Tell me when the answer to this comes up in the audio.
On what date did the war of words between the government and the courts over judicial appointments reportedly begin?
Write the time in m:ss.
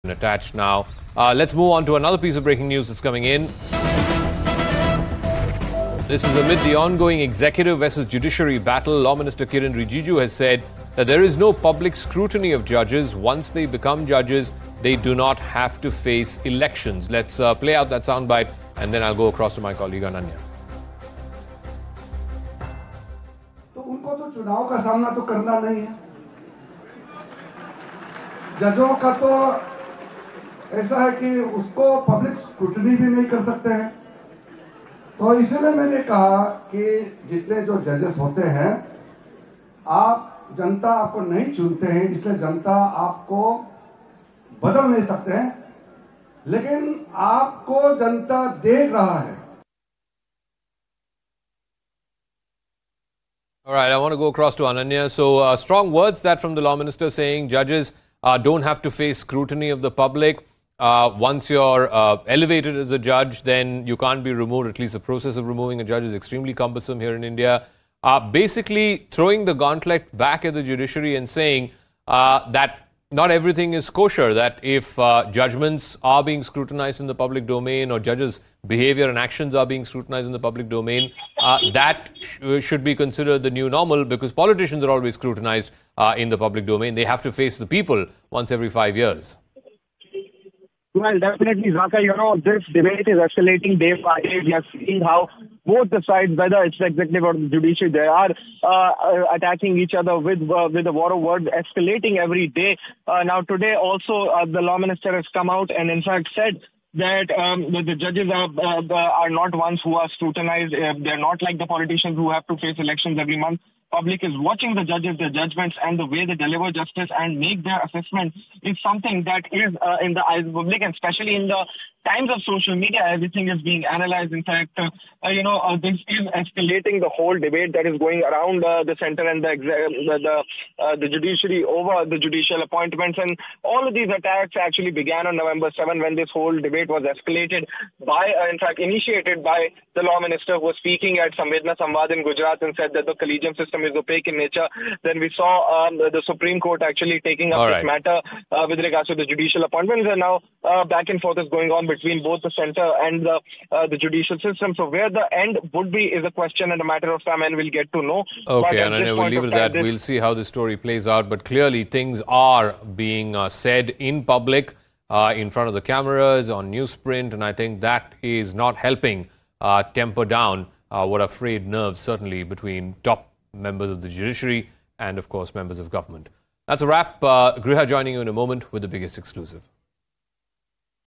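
2:15.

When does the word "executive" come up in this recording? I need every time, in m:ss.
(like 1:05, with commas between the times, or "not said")
0:07, 1:36.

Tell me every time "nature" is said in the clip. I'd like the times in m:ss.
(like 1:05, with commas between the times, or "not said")
2:24.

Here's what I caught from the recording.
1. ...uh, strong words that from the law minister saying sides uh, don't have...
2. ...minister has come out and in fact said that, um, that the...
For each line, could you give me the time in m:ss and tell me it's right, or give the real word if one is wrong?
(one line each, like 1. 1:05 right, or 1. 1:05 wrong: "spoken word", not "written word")
1. 0:55 wrong: "judges", not "sides"
2. 1:44 right.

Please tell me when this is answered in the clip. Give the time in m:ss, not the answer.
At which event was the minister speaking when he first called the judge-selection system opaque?
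2:21.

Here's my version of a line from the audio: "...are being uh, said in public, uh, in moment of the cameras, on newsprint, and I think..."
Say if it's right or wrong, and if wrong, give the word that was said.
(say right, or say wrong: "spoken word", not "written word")
wrong: "front", not "moment".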